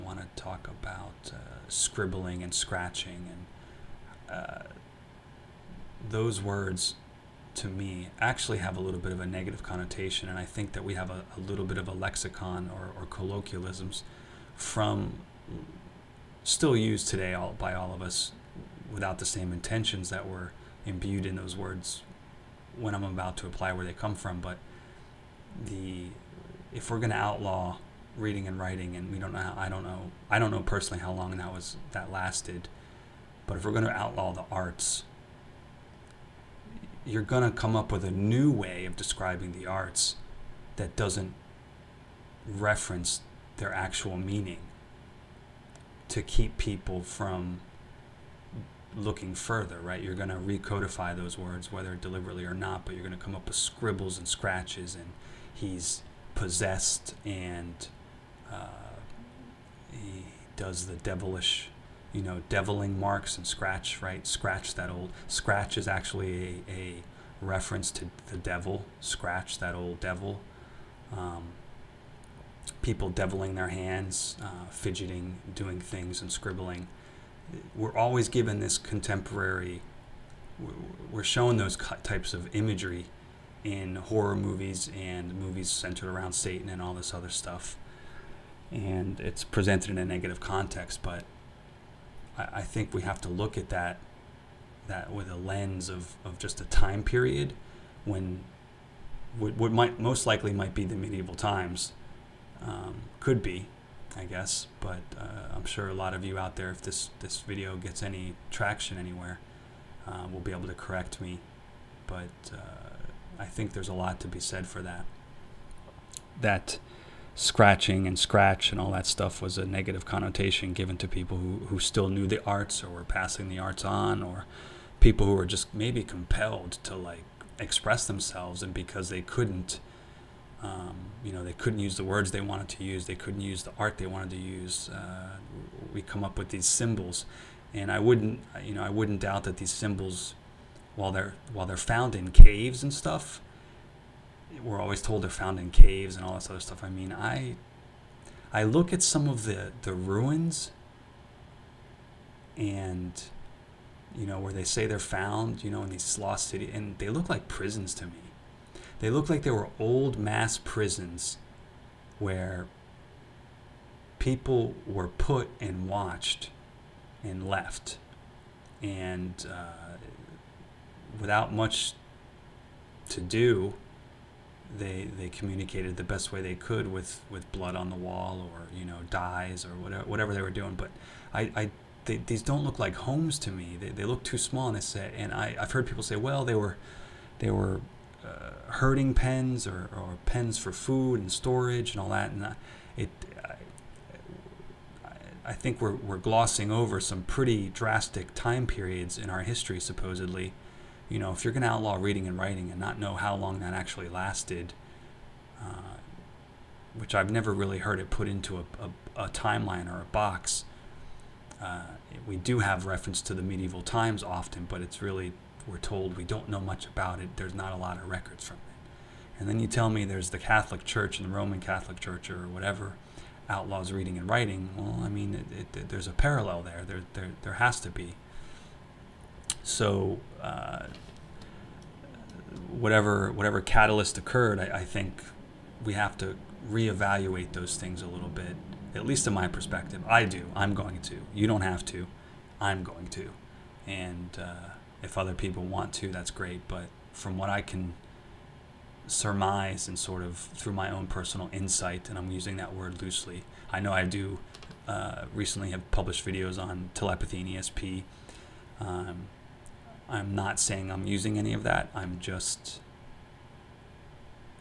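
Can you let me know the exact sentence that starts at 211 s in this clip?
Uh, we do have reference to the medieval times often, but it's really, we're told we don't know much about it.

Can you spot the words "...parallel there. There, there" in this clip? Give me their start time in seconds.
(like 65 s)
226 s.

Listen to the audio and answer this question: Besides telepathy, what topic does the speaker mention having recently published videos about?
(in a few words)
ESP.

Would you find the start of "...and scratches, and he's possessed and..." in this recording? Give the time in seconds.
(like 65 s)
54 s.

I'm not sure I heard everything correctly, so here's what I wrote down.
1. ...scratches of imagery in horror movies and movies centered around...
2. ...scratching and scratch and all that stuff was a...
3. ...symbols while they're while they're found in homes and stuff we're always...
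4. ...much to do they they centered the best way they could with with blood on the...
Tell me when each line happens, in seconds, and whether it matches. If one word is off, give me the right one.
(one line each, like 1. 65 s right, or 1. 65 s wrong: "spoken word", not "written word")
1. 82 s wrong: "types", not "scratches"
2. 117 s right
3. 139 s wrong: "caves", not "homes"
4. 171 s wrong: "communicated", not "centered".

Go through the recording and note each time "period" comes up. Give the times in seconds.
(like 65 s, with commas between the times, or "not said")
97 s, 198 s.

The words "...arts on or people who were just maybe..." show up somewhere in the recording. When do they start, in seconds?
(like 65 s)
123 s.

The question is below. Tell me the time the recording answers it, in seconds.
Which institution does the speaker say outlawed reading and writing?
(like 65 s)
221 s.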